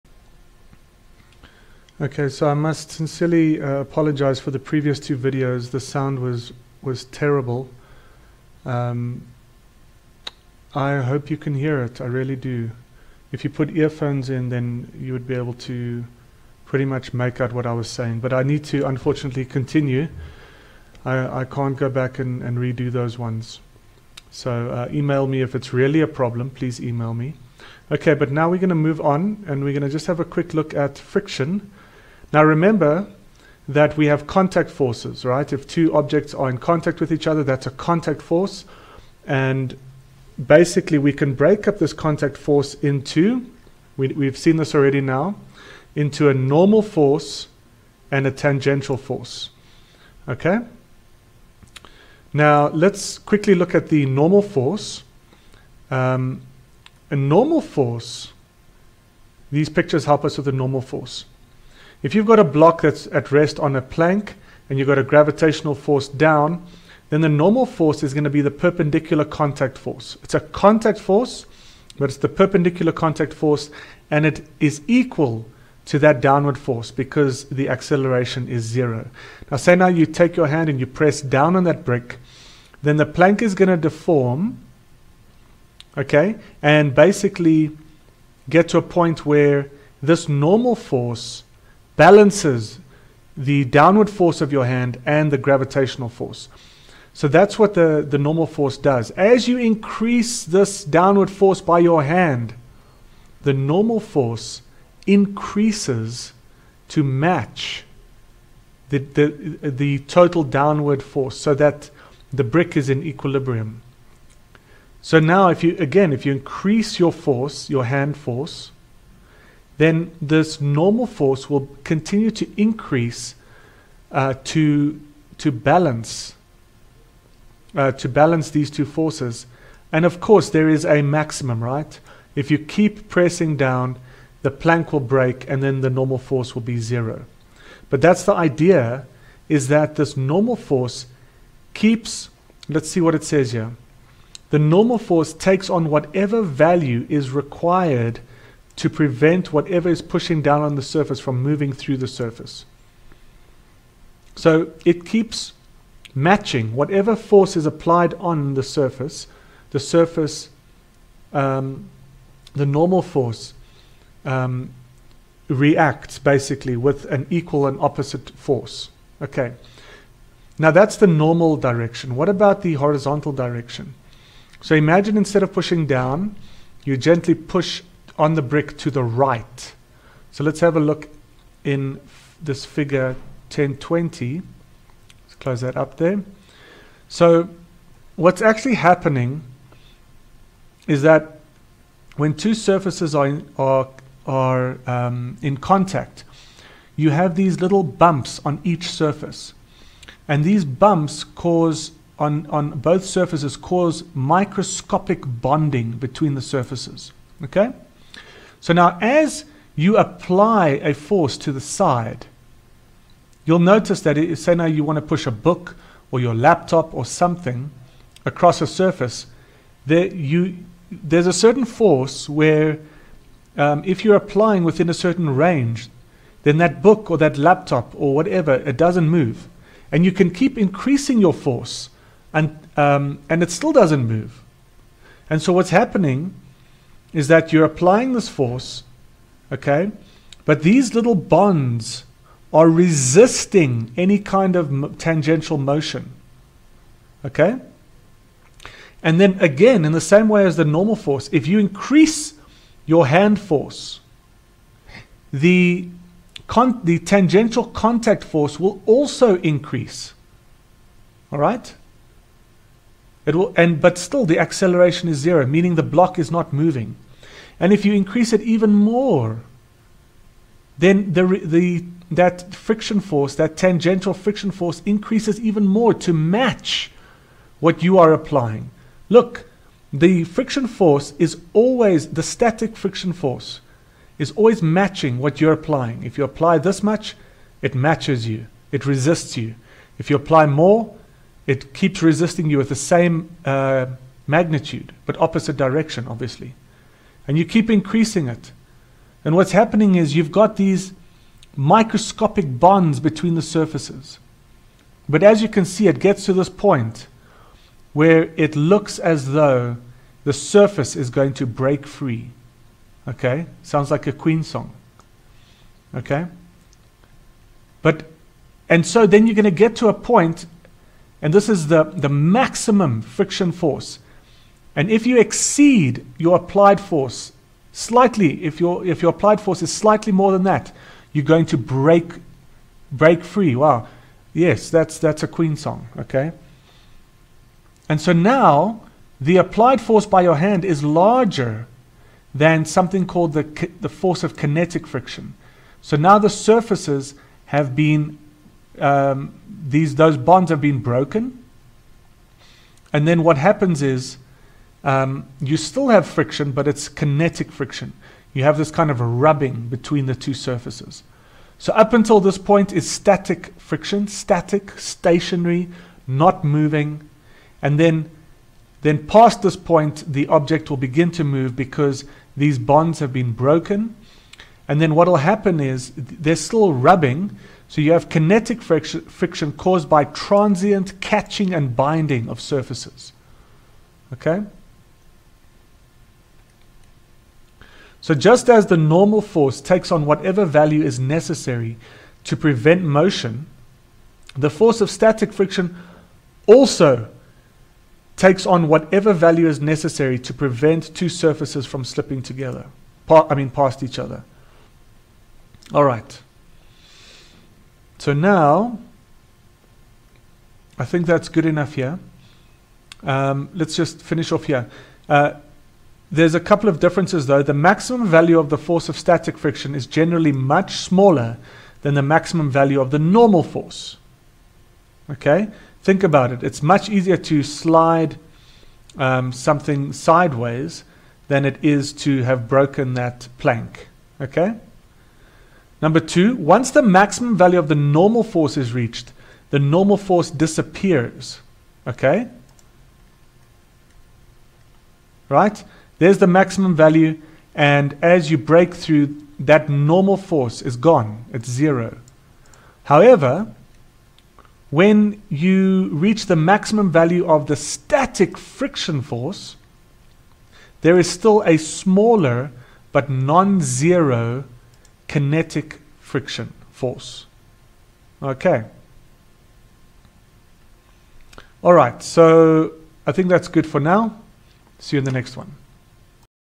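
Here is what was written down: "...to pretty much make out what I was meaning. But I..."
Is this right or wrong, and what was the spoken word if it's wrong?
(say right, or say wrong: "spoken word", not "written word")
wrong: "saying", not "meaning".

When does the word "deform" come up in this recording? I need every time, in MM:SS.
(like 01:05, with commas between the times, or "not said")
01:23.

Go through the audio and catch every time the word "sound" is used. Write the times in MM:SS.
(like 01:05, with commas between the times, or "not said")
00:05, 05:13.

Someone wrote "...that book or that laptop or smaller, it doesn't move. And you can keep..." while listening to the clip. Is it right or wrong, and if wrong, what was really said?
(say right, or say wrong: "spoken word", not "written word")
wrong: "whatever", not "smaller".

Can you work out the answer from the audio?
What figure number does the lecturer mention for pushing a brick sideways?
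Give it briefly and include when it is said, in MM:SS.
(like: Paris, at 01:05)
Figure 1020, at 03:02.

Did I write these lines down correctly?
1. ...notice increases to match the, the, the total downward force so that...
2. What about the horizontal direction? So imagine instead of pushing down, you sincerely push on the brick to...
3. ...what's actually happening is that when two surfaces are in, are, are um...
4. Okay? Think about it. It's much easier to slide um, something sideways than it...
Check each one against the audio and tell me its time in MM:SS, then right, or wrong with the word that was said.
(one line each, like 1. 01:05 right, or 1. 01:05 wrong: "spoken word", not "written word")
1. 01:43 wrong: "force", not "notice"
2. 02:52 wrong: "gently", not "sincerely"
3. 03:08 right
4. 07:05 right.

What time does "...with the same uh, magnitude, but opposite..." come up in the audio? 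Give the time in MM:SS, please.
04:52.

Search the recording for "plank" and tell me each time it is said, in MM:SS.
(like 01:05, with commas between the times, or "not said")
01:03, 01:23, 02:14, 07:13.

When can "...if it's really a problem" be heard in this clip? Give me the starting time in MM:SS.
00:25.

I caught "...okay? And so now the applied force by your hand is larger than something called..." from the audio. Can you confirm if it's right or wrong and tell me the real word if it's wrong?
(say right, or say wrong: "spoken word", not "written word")
right.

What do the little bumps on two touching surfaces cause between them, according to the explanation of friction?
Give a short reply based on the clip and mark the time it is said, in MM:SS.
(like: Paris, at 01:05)
Microscopic bonding, at 03:24.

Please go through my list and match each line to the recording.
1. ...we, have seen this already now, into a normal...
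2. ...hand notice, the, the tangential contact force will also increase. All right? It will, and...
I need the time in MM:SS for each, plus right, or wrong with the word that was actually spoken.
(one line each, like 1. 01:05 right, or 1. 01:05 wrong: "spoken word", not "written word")
1. 00:43 right
2. 04:13 wrong: "force", not "notice".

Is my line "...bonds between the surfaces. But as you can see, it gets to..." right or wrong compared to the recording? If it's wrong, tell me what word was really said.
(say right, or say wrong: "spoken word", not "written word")
right.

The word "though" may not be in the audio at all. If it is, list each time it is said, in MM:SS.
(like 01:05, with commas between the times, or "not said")
05:09, 06:57.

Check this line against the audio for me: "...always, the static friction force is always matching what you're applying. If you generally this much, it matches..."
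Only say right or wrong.
wrong.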